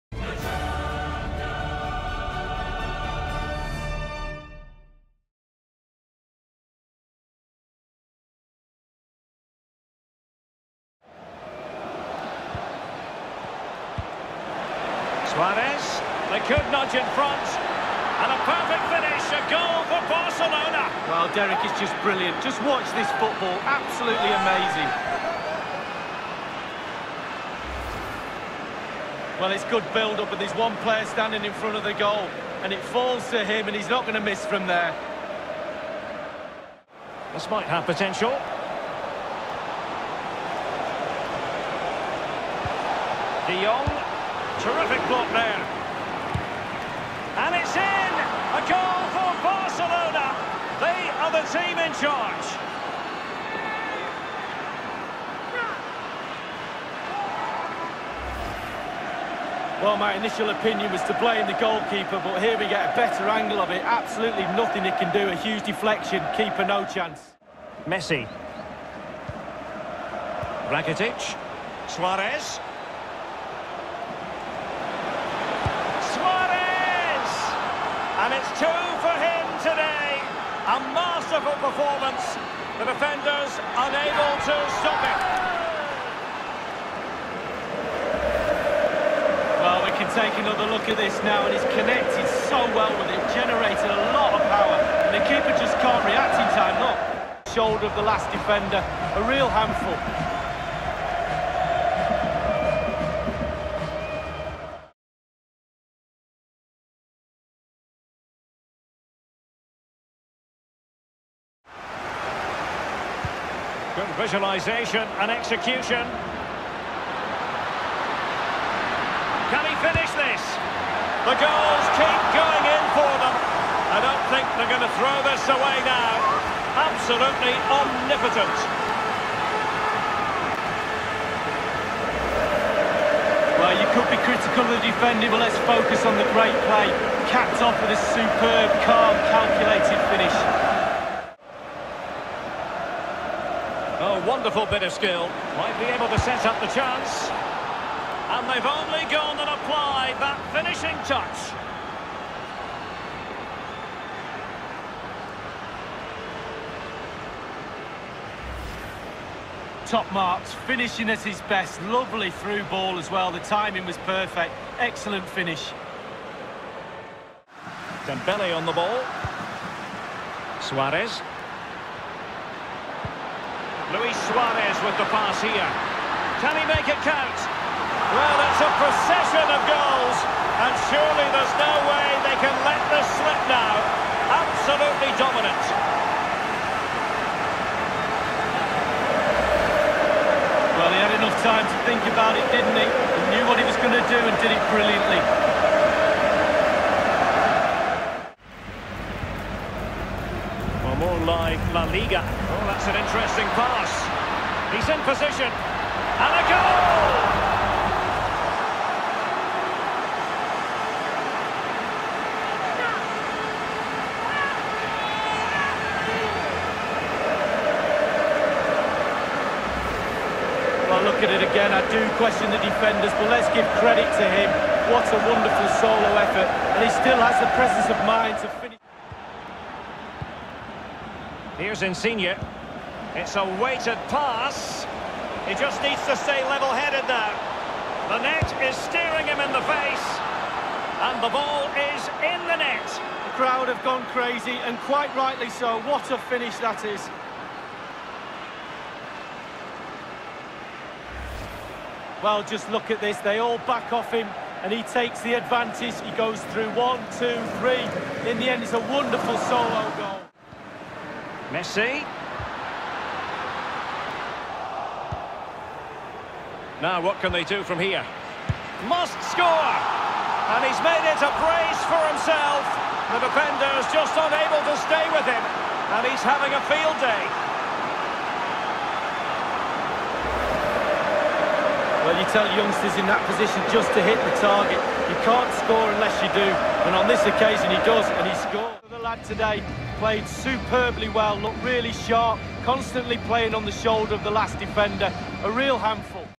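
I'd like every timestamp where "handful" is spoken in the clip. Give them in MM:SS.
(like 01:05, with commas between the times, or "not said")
01:39, 04:55.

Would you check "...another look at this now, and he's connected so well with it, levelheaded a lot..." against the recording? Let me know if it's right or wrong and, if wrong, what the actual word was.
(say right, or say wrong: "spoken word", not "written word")
wrong: "generated", not "levelheaded".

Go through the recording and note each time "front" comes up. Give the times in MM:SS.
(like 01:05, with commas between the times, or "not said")
00:17, 00:31.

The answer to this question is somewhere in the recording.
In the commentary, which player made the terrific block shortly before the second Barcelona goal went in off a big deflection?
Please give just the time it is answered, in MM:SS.
00:43.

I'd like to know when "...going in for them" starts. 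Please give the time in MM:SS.
02:02.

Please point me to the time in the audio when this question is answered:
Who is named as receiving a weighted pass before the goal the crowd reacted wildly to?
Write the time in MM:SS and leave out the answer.
03:51.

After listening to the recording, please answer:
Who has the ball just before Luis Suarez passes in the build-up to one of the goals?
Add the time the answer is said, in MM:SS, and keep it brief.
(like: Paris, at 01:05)
Dembele, at 02:48.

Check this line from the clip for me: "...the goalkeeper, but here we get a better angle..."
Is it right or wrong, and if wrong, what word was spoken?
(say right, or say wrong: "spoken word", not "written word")
right.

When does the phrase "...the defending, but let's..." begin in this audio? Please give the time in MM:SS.
02:14.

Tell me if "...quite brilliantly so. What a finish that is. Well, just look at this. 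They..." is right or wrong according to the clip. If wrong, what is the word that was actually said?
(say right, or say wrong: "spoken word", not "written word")
wrong: "rightly", not "brilliantly".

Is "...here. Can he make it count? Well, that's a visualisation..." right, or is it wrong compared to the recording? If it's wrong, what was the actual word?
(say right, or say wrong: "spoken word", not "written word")
wrong: "procession", not "visualisation".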